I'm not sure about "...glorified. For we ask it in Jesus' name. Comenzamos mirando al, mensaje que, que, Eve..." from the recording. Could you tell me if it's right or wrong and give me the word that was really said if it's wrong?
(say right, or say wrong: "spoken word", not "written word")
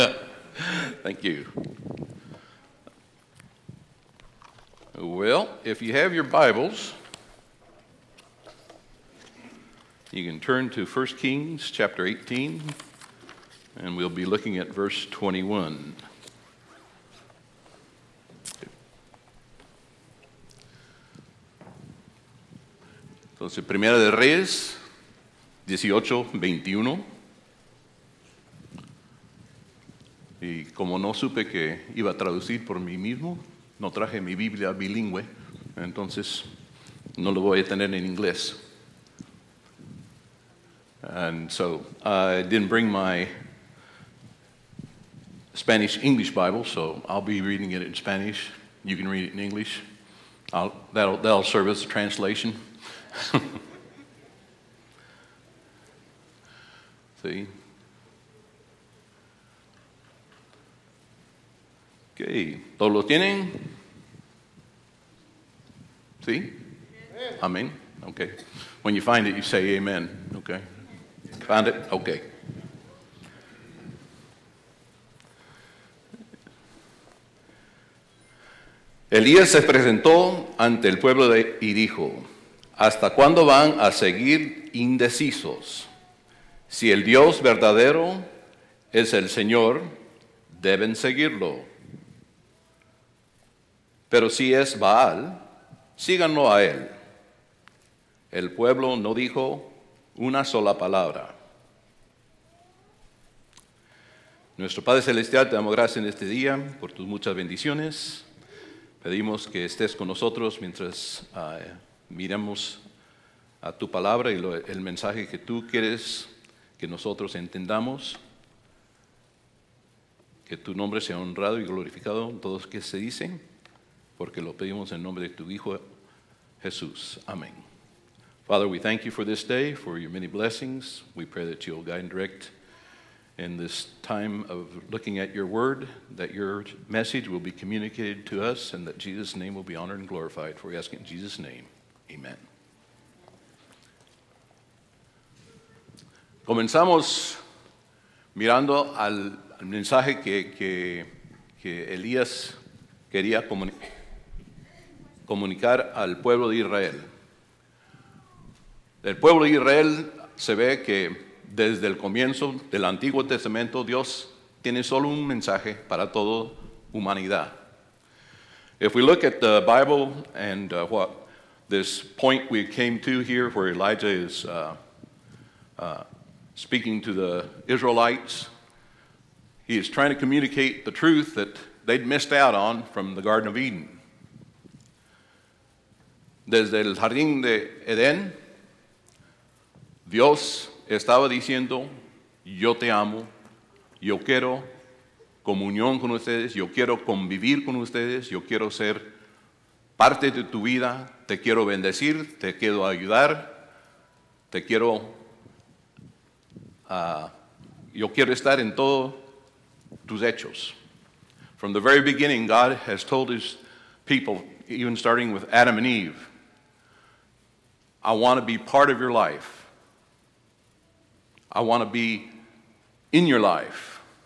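wrong: "Elías", not "Eve".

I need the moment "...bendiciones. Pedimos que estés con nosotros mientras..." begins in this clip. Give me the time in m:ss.
1:47.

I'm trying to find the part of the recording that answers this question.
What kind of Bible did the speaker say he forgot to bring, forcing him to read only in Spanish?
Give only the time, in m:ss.
0:45.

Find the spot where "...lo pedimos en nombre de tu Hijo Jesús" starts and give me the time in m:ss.
2:04.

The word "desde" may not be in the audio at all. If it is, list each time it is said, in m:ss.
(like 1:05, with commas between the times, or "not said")
2:41, 3:06.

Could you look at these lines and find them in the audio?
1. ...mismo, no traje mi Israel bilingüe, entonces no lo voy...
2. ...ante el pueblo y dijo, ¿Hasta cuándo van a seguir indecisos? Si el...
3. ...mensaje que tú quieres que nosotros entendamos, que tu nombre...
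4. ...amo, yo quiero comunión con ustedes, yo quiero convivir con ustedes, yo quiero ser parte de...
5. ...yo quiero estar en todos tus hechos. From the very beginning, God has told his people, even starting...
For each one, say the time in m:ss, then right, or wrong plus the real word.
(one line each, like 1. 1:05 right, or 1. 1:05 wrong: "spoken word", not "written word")
1. 0:32 wrong: "Biblia", not "Israel"
2. 1:20 right
3. 1:54 right
4. 3:12 right
5. 3:27 right.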